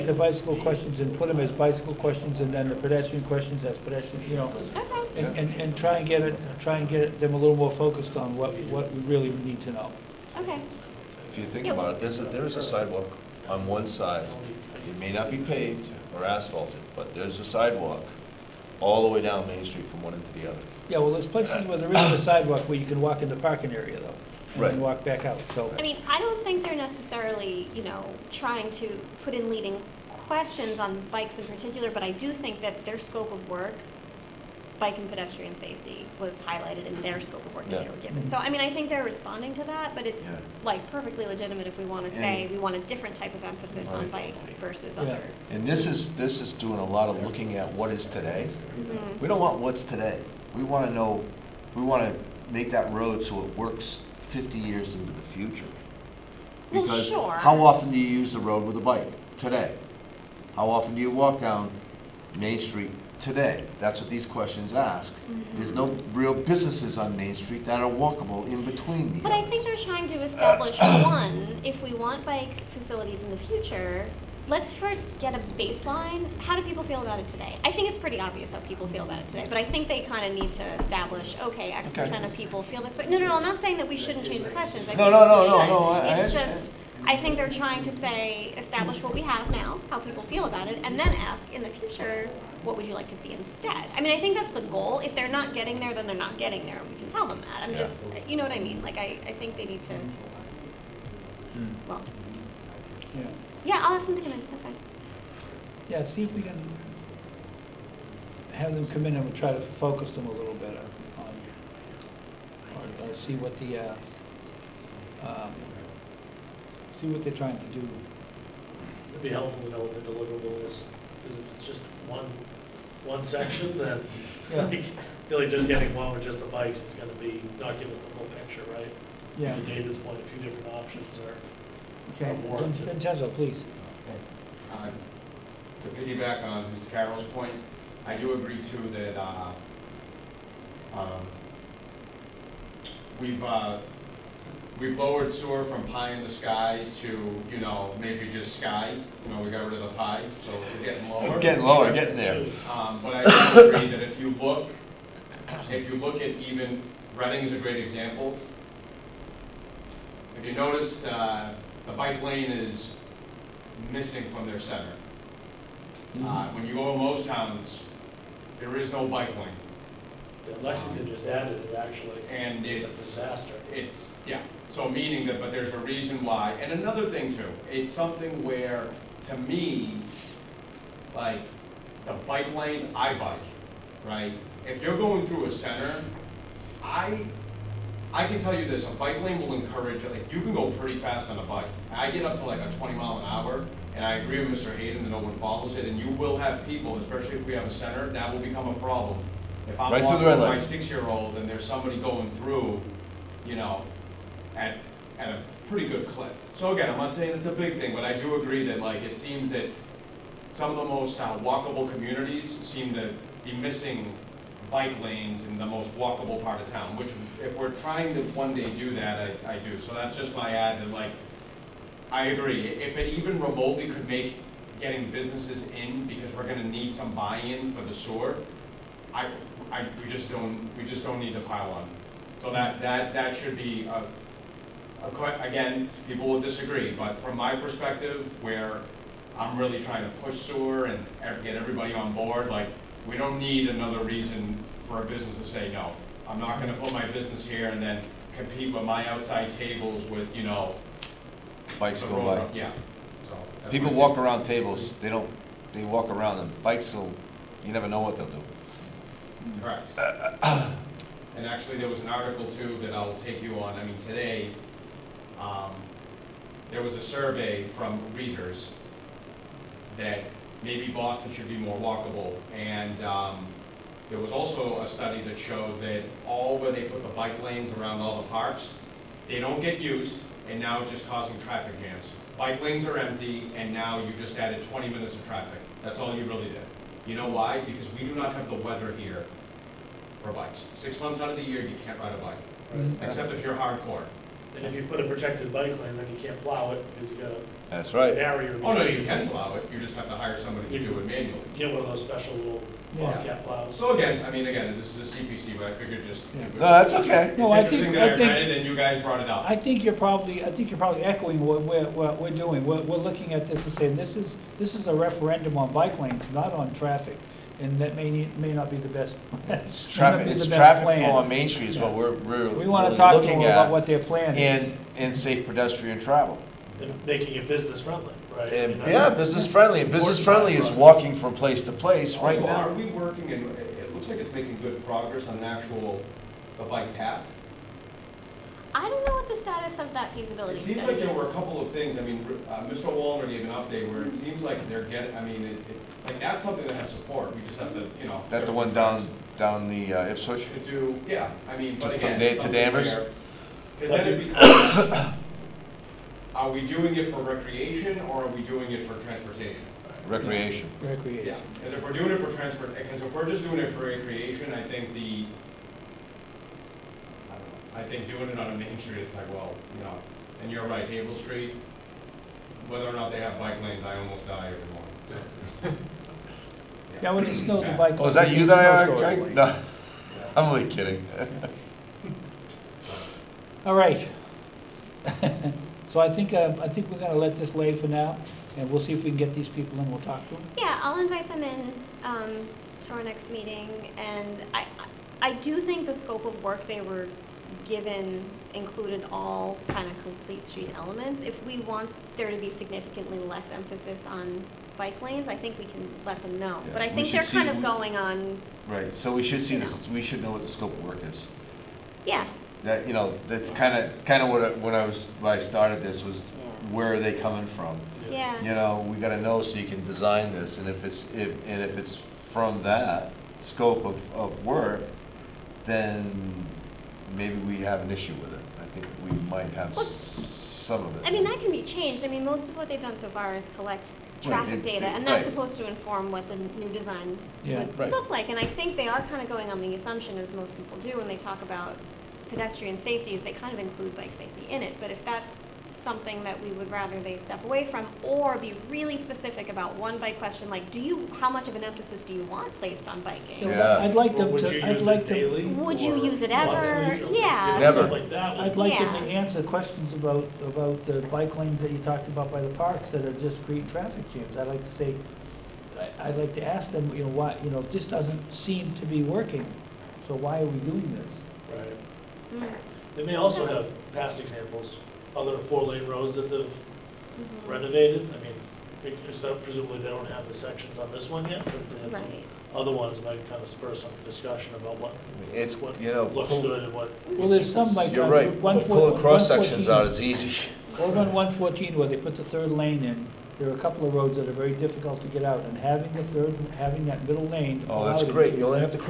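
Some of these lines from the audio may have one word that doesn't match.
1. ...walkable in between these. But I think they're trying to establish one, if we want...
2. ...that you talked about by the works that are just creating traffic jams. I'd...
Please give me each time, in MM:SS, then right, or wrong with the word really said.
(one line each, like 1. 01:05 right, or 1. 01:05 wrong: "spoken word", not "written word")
1. 01:08 right
2. 07:41 wrong: "parks", not "works".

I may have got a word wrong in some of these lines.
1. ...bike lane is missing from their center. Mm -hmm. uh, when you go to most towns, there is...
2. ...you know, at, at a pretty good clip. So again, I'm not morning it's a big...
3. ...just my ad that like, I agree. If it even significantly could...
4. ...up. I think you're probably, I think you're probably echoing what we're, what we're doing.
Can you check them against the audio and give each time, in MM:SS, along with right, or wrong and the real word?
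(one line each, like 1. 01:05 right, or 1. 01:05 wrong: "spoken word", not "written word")
1. 02:41 right
2. 03:23 wrong: "saying", not "morning"
3. 03:40 wrong: "remotely", not "significantly"
4. 05:09 right.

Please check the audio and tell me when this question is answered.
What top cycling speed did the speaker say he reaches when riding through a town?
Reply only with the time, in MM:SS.
03:12.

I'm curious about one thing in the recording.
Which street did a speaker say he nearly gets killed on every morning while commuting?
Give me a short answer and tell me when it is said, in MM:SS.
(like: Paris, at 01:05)
Haverhill Street, at 06:10.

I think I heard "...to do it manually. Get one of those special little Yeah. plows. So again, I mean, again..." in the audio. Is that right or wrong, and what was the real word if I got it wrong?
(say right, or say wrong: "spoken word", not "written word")
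right.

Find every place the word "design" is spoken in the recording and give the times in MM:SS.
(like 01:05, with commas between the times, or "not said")
06:59, 07:16.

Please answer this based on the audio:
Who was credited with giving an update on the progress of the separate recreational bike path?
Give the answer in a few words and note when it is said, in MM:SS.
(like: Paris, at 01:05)
Mr. Wallner, at 05:42.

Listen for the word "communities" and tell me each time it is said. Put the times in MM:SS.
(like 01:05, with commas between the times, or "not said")
03:31.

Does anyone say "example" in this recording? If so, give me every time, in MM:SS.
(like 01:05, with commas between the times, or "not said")
02:37, 07:54.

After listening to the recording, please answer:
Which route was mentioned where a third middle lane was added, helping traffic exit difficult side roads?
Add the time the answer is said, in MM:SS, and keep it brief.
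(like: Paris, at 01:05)
Route 114, at 08:11.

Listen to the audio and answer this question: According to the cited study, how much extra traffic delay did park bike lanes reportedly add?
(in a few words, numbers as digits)
20 minutes.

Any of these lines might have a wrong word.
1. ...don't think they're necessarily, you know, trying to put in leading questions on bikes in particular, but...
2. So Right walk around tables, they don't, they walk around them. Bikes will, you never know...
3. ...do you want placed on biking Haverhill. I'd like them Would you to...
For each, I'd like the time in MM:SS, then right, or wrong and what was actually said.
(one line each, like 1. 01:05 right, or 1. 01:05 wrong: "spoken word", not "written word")
1. 00:26 right
2. 04:13 wrong: "People", not "Right"
3. 07:32 wrong: "Yeah", not "Haverhill".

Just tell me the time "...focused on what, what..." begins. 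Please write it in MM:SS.
00:07.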